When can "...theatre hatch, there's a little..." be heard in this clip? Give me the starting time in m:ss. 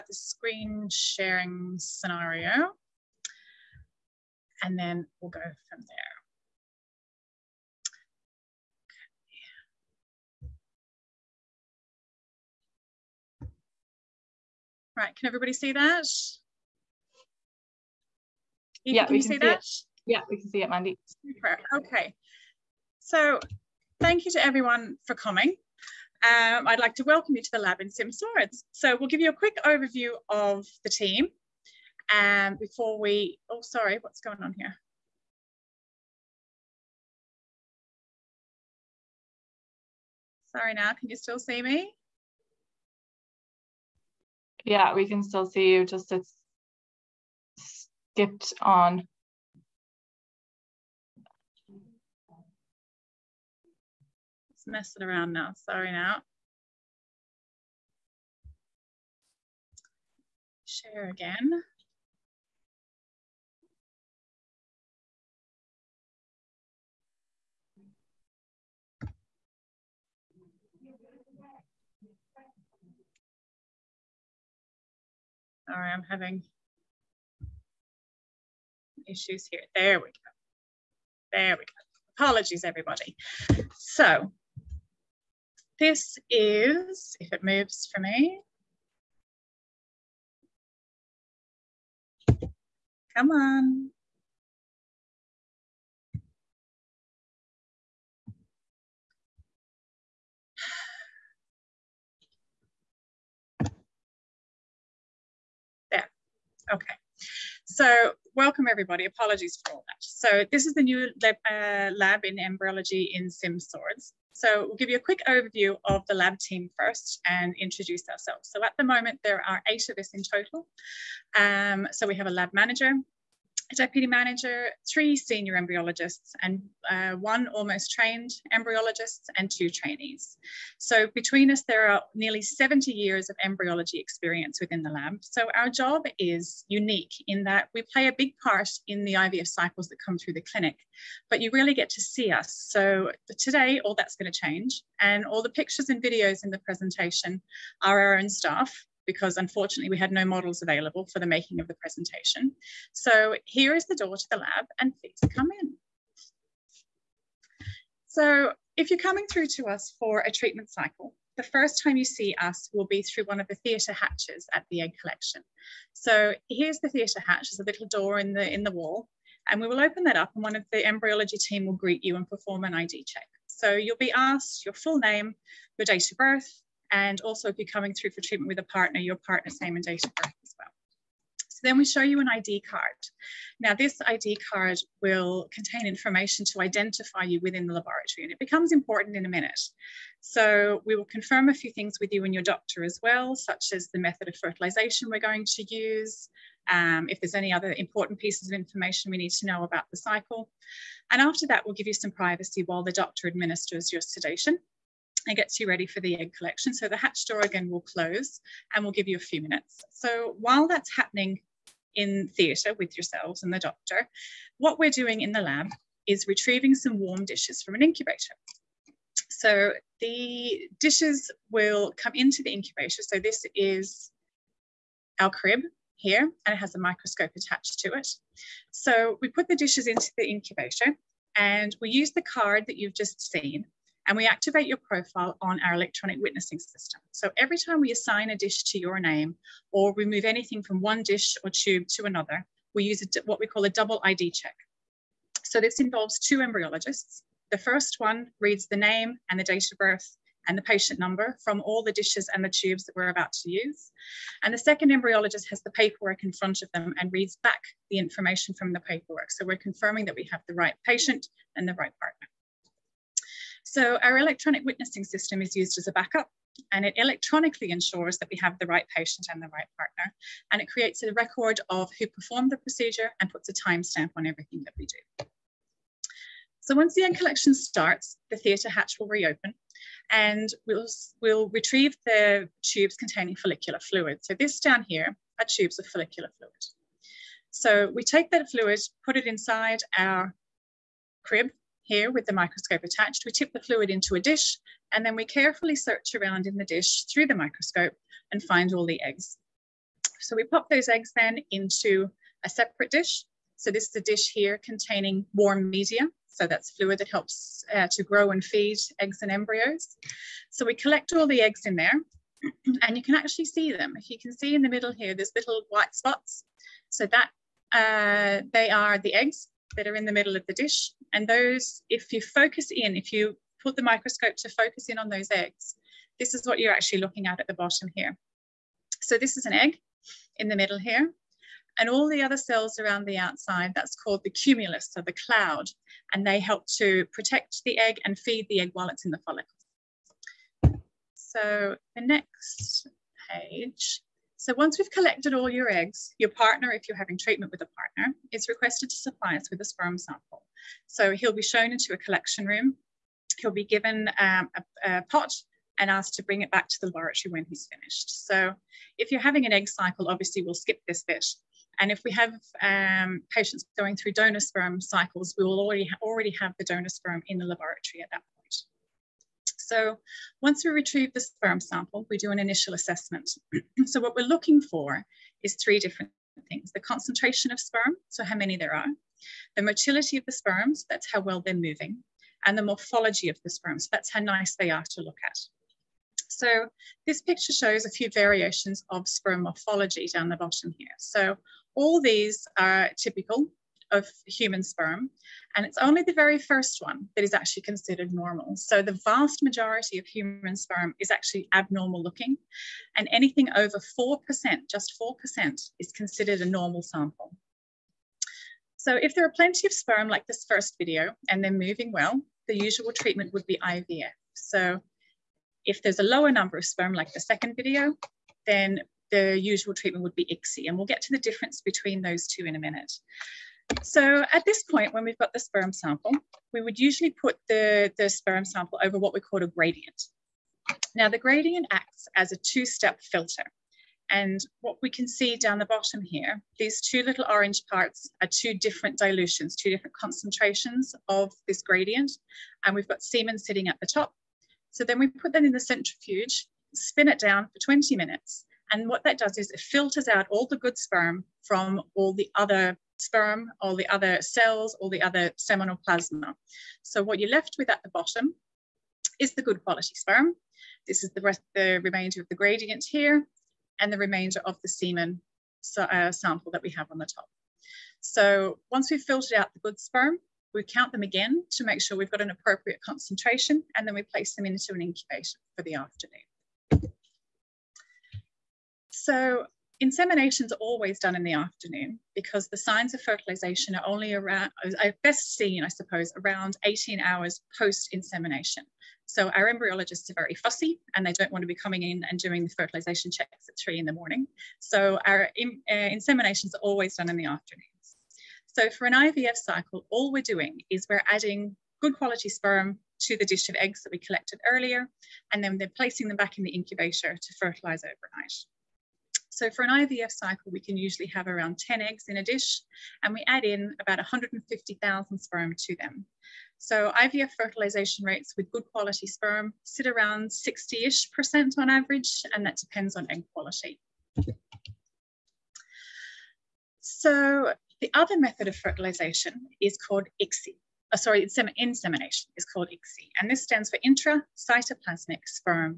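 2:46.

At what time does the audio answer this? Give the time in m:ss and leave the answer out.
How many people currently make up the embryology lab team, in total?
1:59.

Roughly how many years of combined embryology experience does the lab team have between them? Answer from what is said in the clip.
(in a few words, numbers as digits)
70.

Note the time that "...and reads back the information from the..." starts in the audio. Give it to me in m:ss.
4:16.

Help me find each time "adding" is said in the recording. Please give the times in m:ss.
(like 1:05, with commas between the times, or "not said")
8:21.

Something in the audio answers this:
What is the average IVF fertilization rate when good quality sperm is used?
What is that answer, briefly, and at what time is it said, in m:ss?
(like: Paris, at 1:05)
60%, at 8:40.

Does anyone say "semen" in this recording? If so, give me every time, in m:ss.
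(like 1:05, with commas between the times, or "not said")
7:23, 7:44.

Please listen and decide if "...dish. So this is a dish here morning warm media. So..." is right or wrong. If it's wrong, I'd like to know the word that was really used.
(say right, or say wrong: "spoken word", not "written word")
wrong: "containing", not "morning".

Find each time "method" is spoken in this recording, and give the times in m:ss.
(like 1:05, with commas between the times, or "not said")
3:13, 8:48.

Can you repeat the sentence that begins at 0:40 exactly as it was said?
Sorry now, can you still see me?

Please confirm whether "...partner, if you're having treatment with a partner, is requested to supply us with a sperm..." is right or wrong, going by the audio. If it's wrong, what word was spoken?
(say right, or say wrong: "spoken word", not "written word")
right.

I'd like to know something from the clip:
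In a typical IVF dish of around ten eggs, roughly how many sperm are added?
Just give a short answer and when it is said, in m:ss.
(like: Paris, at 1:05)
150,000, at 8:33.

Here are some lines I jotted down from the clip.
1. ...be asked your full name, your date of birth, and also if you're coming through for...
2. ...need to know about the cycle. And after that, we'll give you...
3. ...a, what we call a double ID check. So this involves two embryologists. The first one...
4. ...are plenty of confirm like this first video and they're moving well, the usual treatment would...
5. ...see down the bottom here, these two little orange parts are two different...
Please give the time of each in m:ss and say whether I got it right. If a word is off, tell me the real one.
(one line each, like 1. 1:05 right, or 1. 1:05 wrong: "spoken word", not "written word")
1. 2:53 right
2. 3:19 right
3. 4:03 right
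4. 6:49 wrong: "sperm", not "confirm"
5. 7:15 right.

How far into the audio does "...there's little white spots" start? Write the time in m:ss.
5:15.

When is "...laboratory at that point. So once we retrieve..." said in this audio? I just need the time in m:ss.
6:07.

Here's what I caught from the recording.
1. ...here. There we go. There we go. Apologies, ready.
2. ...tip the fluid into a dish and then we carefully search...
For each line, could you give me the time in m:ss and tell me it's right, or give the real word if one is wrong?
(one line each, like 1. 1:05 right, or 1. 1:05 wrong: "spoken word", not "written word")
1. 1:19 wrong: "everybody", not "ready"
2. 4:53 right.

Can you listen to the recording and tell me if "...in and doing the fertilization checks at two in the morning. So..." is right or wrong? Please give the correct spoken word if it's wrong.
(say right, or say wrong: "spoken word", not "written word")
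wrong: "three", not "two".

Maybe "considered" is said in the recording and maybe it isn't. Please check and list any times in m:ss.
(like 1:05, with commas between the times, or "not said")
6:37, 6:45.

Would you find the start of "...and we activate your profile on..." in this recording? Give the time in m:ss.
3:54.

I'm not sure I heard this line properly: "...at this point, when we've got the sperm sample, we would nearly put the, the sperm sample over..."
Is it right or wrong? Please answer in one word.
wrong.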